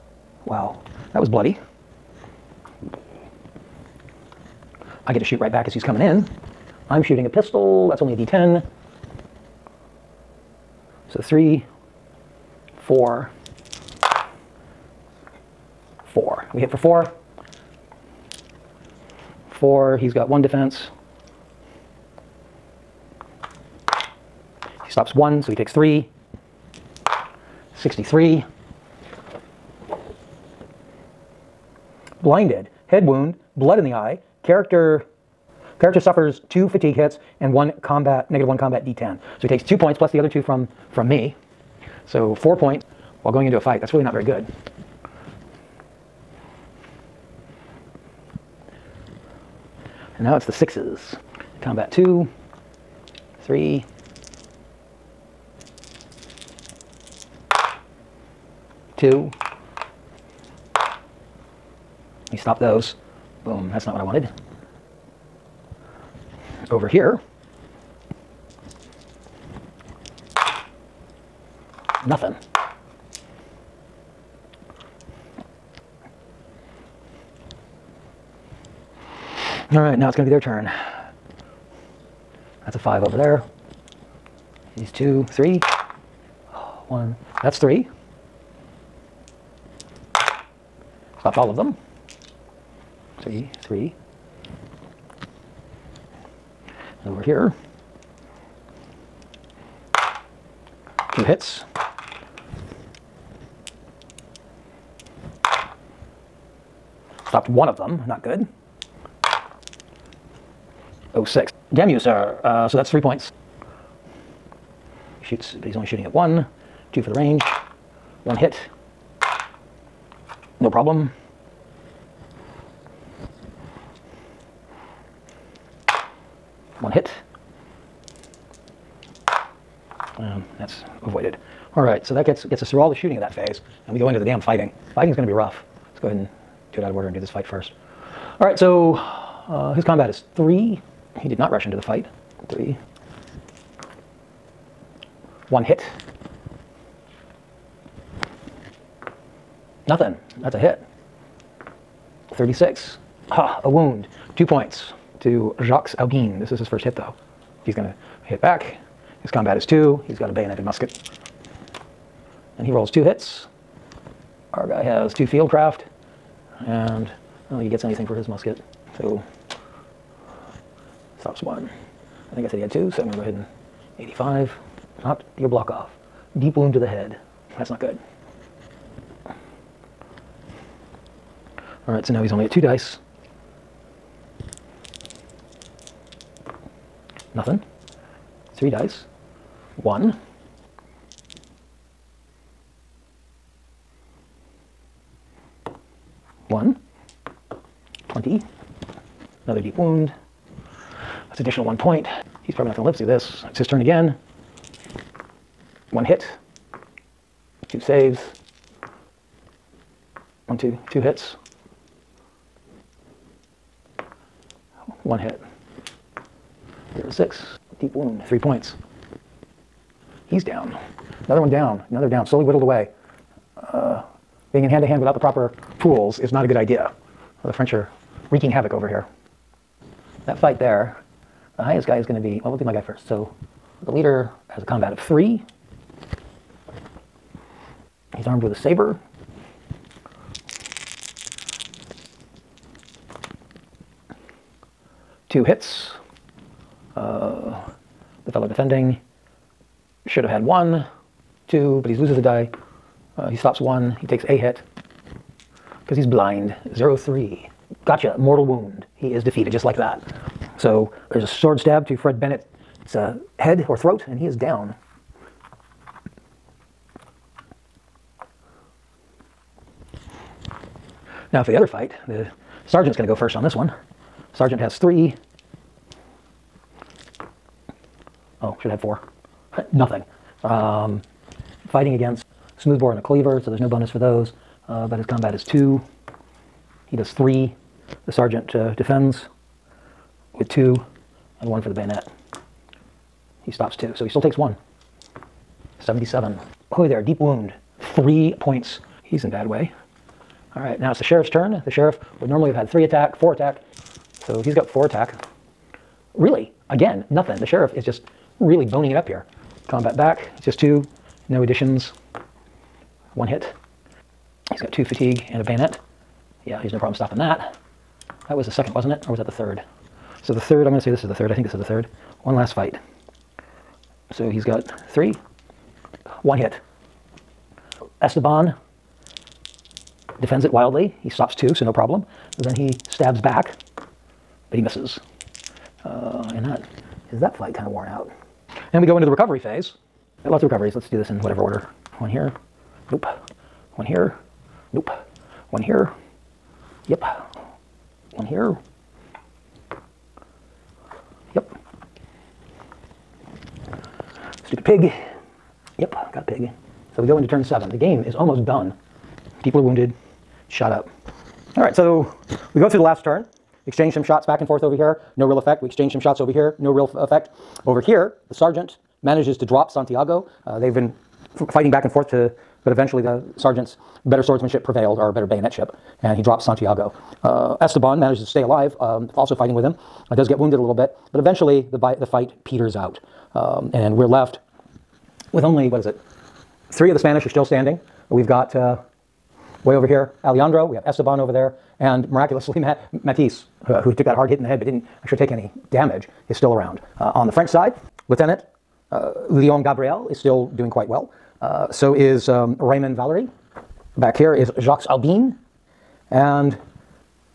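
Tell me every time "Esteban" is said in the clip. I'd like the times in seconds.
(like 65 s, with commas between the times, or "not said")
328 s, 377 s, 390 s.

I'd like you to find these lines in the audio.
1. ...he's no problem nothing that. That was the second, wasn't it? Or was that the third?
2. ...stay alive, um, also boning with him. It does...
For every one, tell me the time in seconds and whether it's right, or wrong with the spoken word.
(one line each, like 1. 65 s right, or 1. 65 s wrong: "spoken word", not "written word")
1. 316 s wrong: "stopping", not "nothing"
2. 378 s wrong: "fighting", not "boning".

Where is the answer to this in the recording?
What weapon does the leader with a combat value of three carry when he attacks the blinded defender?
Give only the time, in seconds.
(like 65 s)
238 s.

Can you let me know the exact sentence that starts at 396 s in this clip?
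Uh, on the French side, Lieutenant uh, Leon Gabriel is still doing quite well.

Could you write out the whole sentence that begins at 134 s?
Fighting is going to be rough.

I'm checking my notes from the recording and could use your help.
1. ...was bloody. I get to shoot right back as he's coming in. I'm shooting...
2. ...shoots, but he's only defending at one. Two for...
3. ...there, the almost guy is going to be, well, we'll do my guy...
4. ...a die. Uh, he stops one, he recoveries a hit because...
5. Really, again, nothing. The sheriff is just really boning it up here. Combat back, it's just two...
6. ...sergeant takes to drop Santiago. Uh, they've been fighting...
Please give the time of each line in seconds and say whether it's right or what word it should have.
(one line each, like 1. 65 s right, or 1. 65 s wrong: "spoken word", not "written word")
1. 1 s right
2. 115 s wrong: "shooting", not "defending"
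3. 230 s wrong: "highest", not "almost"
4. 252 s wrong: "takes", not "recoveries"
5. 306 s right
6. 368 s wrong: "manages", not "takes".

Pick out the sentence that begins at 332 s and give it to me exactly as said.
Then he stabs back, but he misses.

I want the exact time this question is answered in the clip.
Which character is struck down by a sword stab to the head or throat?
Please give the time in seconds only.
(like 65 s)
261 s.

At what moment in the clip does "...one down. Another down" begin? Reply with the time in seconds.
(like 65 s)
221 s.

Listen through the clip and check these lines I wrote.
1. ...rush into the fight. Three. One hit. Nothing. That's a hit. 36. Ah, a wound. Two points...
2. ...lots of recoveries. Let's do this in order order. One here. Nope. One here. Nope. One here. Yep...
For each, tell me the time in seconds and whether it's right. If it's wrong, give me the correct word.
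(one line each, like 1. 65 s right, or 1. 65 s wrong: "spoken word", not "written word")
1. 141 s right
2. 340 s wrong: "whatever", not "order".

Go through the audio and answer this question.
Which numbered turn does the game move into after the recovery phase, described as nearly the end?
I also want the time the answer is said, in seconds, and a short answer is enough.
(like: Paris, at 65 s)
7, at 357 s.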